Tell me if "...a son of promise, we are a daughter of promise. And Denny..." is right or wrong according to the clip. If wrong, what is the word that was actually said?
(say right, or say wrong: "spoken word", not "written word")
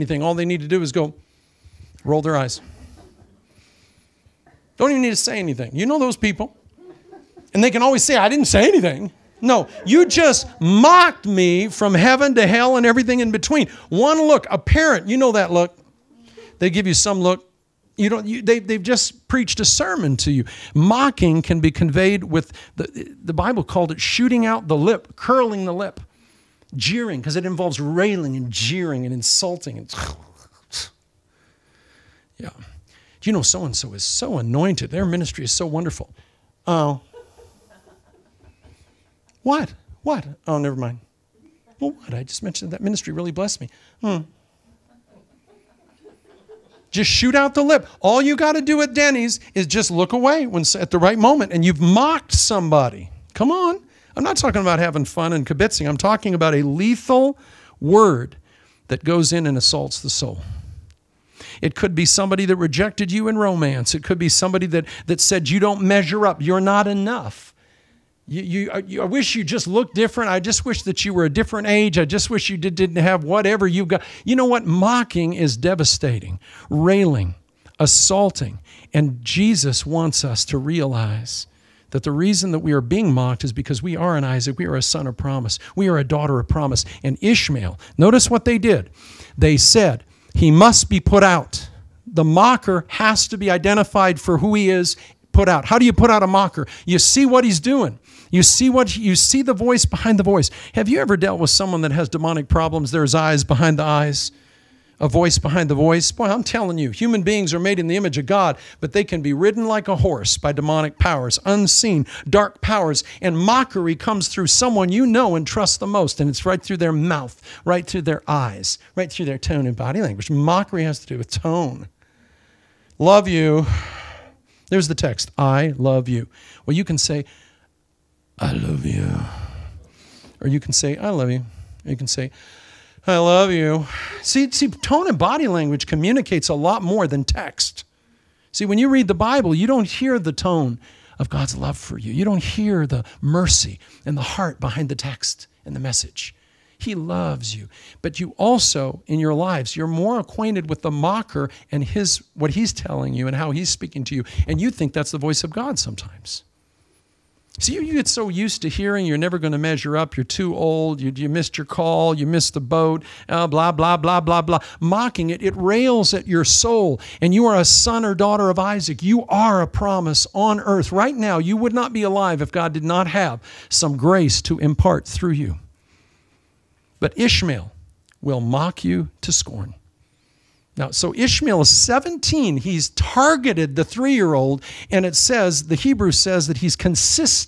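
wrong: "Ishmael", not "Denny".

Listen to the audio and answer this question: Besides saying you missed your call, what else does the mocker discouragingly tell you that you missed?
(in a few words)
The boat.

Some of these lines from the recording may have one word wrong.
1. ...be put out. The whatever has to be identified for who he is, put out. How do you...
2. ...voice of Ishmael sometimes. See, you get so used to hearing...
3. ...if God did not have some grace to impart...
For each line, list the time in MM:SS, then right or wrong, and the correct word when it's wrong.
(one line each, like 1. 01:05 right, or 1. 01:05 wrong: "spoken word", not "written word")
1. 01:30 wrong: "mocker", not "whatever"
2. 02:35 wrong: "God", not "Ishmael"
3. 02:52 right.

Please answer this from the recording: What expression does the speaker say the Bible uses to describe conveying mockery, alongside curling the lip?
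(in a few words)
Shooting out the lip.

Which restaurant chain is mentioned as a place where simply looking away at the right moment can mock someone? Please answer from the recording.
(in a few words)
Denny's.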